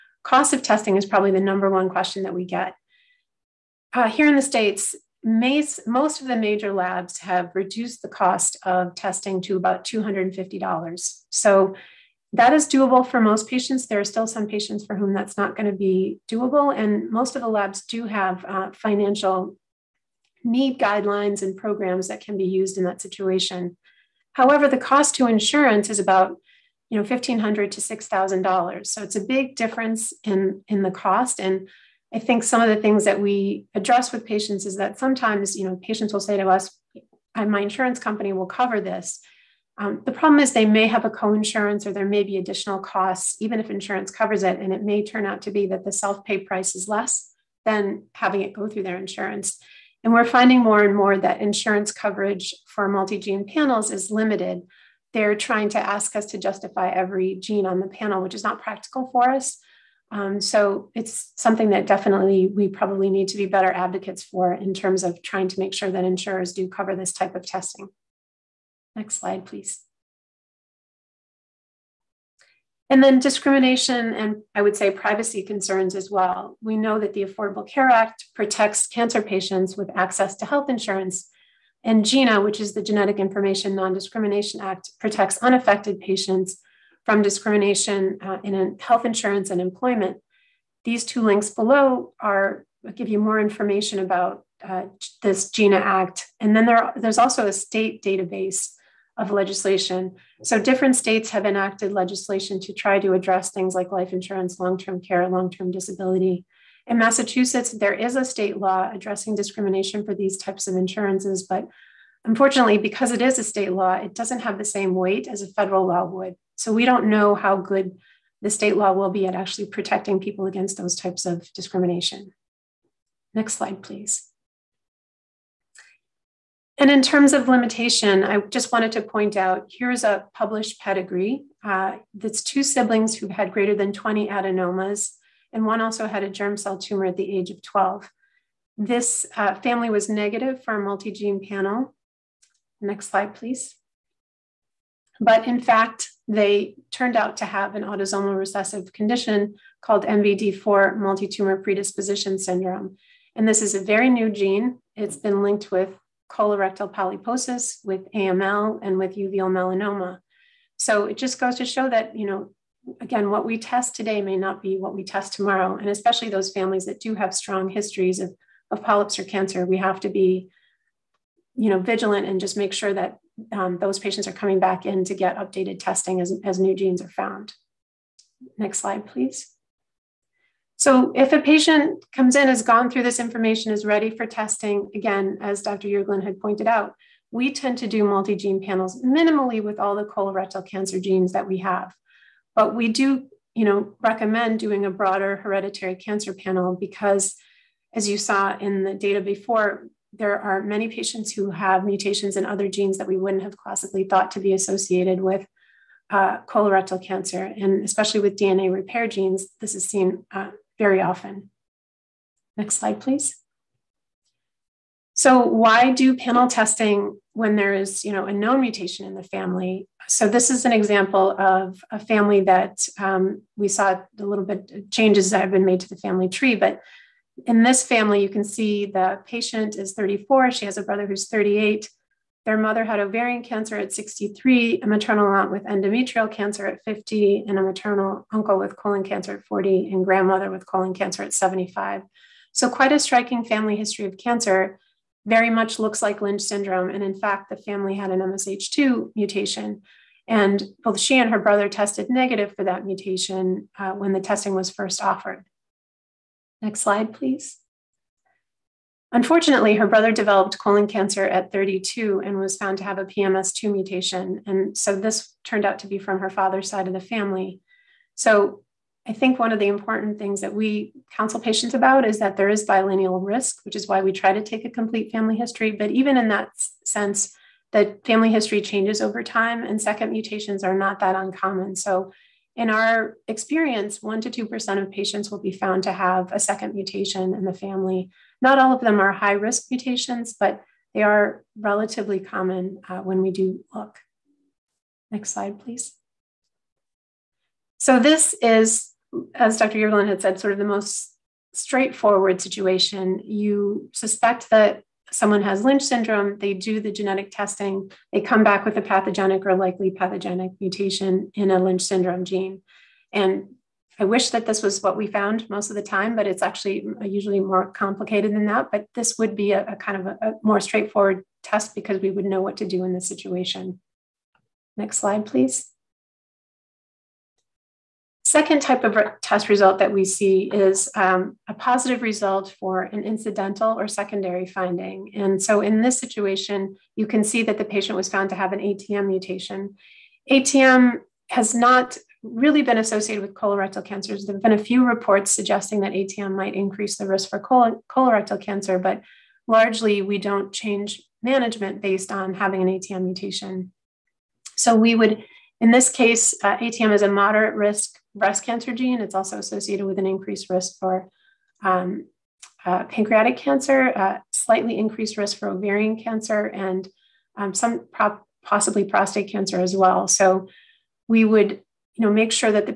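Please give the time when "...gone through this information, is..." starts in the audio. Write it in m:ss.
3:02.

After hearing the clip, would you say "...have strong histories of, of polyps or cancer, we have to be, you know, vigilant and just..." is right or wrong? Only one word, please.
right.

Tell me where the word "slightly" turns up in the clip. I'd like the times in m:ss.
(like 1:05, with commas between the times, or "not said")
6:04.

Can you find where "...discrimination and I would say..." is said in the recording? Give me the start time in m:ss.
1:13.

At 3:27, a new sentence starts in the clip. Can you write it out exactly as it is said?
And especially with DNA repair genes, this is seen uh, very often.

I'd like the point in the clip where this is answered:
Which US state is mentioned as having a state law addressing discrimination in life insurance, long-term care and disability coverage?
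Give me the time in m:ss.
1:46.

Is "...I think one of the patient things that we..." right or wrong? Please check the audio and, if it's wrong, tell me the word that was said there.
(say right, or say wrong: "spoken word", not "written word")
wrong: "important", not "patient".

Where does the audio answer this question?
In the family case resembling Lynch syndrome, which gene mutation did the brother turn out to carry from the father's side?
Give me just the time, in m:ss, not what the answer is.
4:23.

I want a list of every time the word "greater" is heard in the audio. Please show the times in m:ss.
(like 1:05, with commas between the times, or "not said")
2:13.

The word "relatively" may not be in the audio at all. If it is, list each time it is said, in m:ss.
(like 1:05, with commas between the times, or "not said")
4:51.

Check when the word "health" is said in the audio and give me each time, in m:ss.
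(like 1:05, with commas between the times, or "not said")
1:20, 1:28.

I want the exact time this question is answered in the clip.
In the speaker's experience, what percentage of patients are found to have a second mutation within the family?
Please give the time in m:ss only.
4:43.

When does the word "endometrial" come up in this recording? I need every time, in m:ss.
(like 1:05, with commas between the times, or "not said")
3:55.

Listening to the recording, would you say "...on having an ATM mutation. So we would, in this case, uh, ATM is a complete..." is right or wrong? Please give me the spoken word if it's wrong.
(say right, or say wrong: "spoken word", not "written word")
wrong: "moderate", not "complete".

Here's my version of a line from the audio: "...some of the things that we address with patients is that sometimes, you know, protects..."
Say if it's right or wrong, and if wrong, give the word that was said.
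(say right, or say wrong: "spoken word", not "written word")
wrong: "patients", not "protects".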